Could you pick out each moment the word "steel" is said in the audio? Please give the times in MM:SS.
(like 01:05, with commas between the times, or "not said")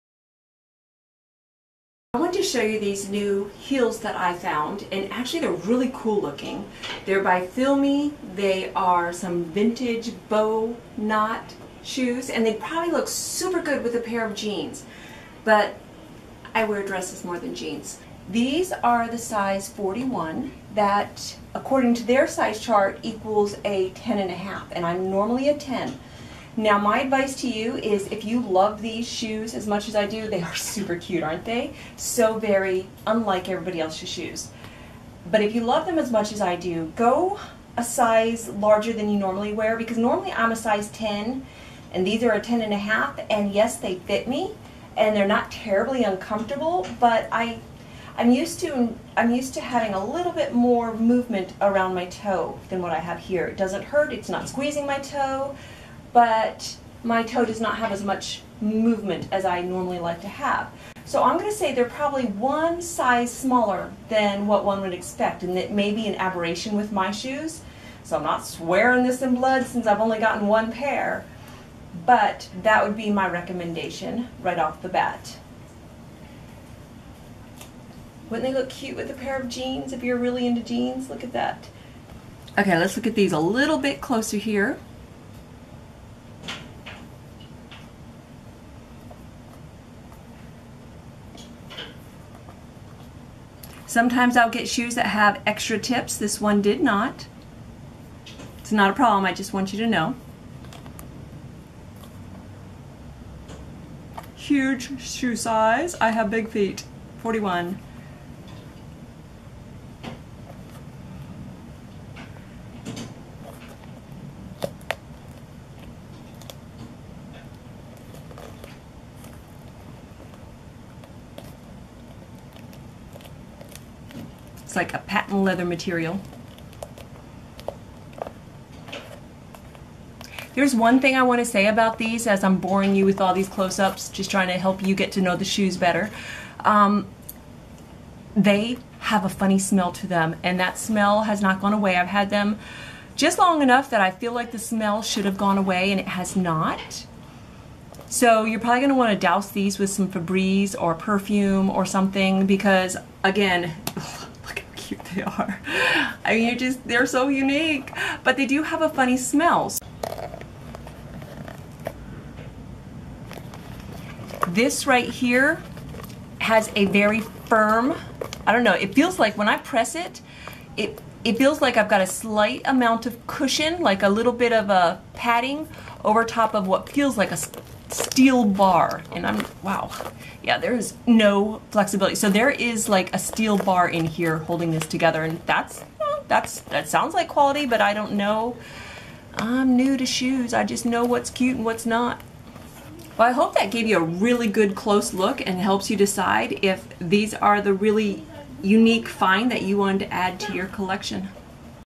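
02:58, 03:03.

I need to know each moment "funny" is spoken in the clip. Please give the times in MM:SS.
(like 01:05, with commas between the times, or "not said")
02:19, 02:38.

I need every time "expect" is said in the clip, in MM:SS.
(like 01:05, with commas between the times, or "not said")
01:04.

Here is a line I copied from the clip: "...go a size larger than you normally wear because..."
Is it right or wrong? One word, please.
right.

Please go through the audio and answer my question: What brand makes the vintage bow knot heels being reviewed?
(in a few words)
FeelMe.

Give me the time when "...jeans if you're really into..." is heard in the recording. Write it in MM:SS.
01:19.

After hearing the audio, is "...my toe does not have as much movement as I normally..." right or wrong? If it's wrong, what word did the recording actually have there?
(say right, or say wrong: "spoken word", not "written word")
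right.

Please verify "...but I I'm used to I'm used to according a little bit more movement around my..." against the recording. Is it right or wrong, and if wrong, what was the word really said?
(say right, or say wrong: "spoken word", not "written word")
wrong: "having", not "according".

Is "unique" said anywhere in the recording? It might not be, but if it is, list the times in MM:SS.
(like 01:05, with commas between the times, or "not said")
02:37, 03:18.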